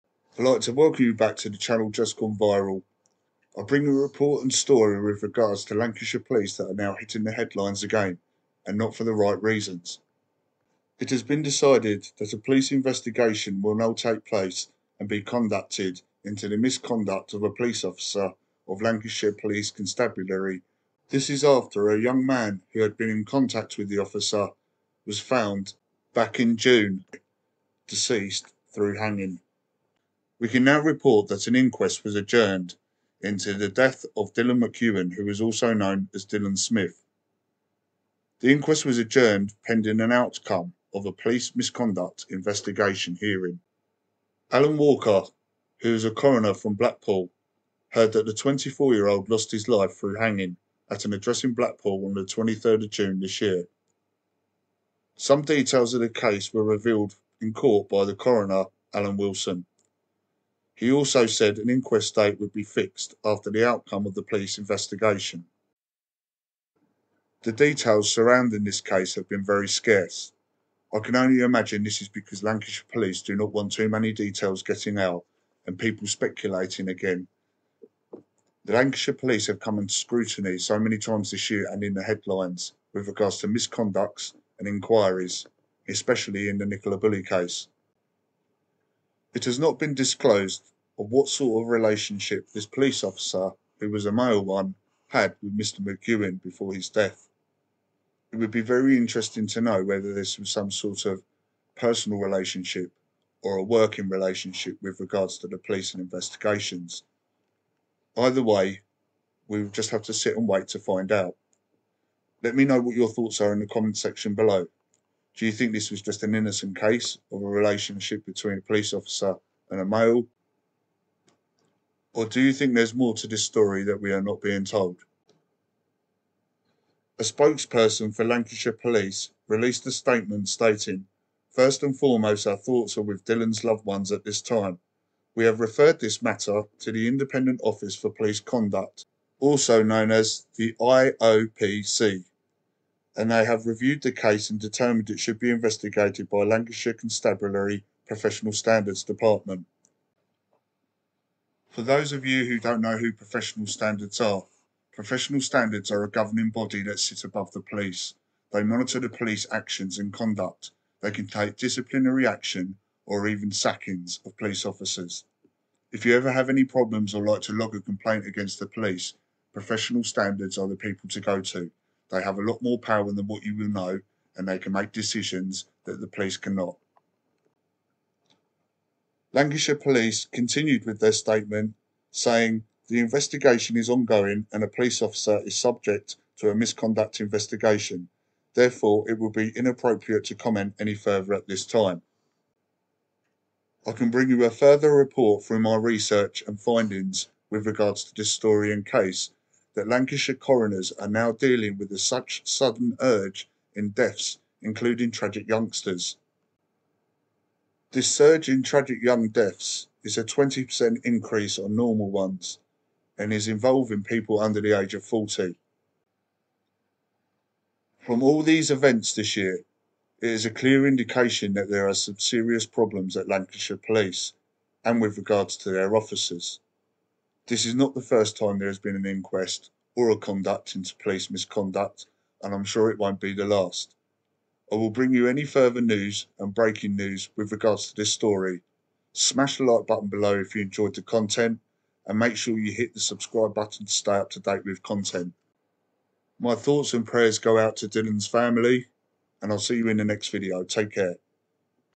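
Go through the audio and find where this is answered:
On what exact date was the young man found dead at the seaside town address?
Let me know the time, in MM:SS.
00:52.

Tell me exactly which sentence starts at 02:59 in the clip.
Lancashire Police continued with their statement saying the investigation is ongoing and a police officer is subject to a misconduct investigation.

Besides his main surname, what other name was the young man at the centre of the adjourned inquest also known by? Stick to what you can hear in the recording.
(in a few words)
Dylan Smith.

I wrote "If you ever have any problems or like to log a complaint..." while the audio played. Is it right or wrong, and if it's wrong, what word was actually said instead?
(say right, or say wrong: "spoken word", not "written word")
right.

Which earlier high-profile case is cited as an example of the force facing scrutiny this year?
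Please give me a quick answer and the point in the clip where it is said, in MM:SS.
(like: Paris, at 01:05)
Nicola Bulley, at 01:26.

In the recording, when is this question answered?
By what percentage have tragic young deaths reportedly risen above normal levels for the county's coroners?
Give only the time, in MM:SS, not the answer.
03:30.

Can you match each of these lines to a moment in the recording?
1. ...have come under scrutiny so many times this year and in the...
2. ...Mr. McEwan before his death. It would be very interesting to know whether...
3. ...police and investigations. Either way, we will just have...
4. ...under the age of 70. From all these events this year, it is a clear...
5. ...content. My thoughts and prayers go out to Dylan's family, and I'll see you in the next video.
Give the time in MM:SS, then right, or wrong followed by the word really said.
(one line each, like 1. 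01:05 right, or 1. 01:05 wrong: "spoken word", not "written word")
1. 01:19 right
2. 01:35 right
3. 01:45 right
4. 03:34 wrong: "40", not "70"
5. 04:04 right.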